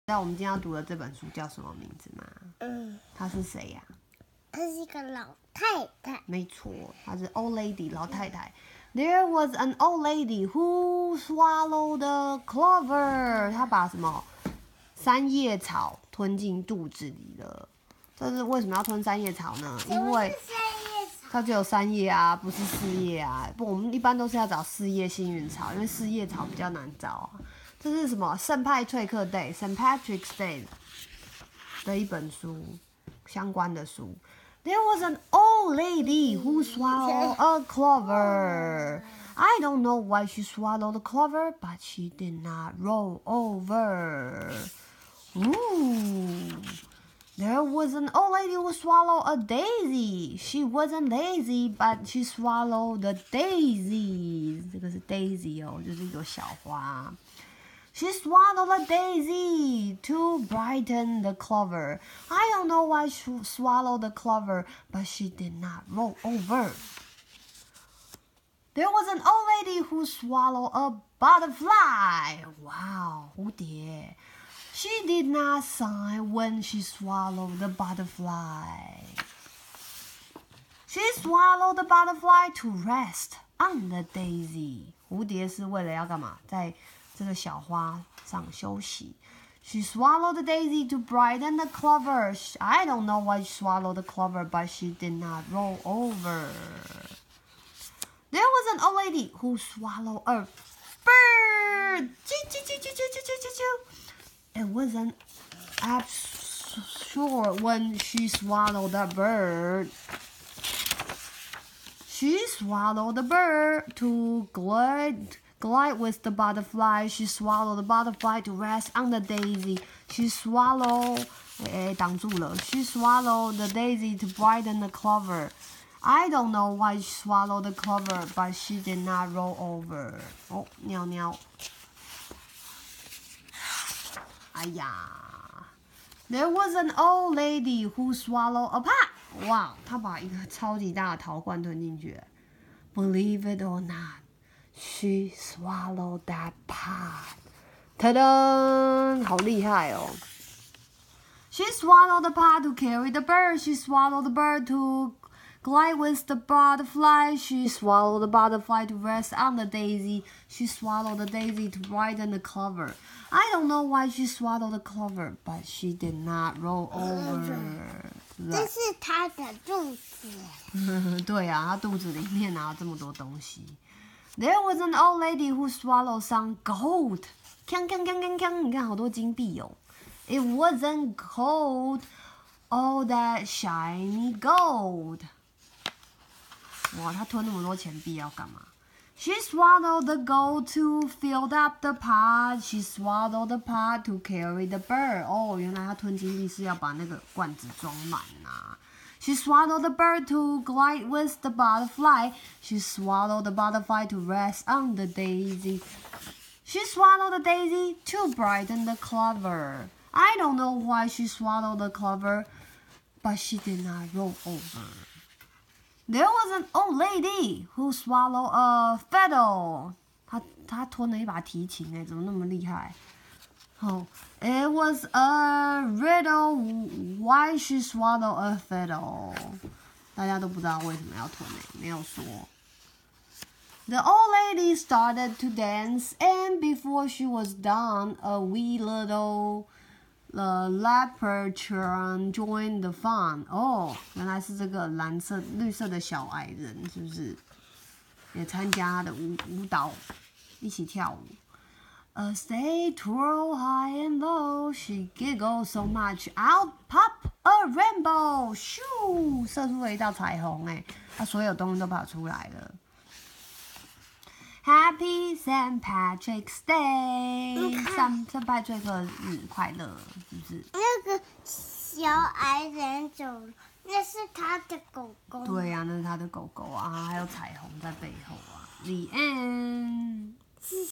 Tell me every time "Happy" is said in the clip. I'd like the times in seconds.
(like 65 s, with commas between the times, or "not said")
264 s.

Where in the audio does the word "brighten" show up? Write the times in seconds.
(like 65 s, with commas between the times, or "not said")
60 s, 90 s, 124 s, 161 s, 208 s.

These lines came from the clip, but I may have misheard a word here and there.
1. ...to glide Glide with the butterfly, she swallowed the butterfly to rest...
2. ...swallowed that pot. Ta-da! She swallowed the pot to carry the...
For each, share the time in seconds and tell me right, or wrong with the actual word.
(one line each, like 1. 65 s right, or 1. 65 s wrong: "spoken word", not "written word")
1. 113 s right
2. 145 s right.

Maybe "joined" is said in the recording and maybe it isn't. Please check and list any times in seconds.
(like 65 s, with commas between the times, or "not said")
242 s.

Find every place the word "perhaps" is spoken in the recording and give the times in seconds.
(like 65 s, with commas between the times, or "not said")
not said.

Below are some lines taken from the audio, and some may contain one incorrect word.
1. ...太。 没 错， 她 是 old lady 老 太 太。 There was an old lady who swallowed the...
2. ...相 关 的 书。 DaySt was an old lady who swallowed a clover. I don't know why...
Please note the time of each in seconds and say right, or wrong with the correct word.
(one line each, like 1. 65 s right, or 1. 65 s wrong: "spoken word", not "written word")
1. 6 s right
2. 33 s wrong: "There", not "DaySt".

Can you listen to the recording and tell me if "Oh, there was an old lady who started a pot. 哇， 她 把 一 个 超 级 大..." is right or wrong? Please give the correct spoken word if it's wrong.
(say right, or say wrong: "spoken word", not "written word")
wrong: "swallowed", not "started".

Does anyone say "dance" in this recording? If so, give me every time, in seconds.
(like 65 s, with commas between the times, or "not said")
235 s.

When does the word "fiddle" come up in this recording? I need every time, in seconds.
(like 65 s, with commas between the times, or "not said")
218 s, 228 s.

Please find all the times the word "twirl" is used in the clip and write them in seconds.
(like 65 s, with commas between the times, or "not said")
252 s.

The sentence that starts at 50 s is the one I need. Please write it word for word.
She wasn't lazy, but she swallowed the daisies.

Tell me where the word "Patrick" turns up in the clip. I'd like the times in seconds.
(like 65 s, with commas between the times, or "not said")
29 s, 265 s.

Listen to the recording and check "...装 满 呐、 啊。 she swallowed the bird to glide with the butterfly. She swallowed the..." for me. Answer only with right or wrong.
right.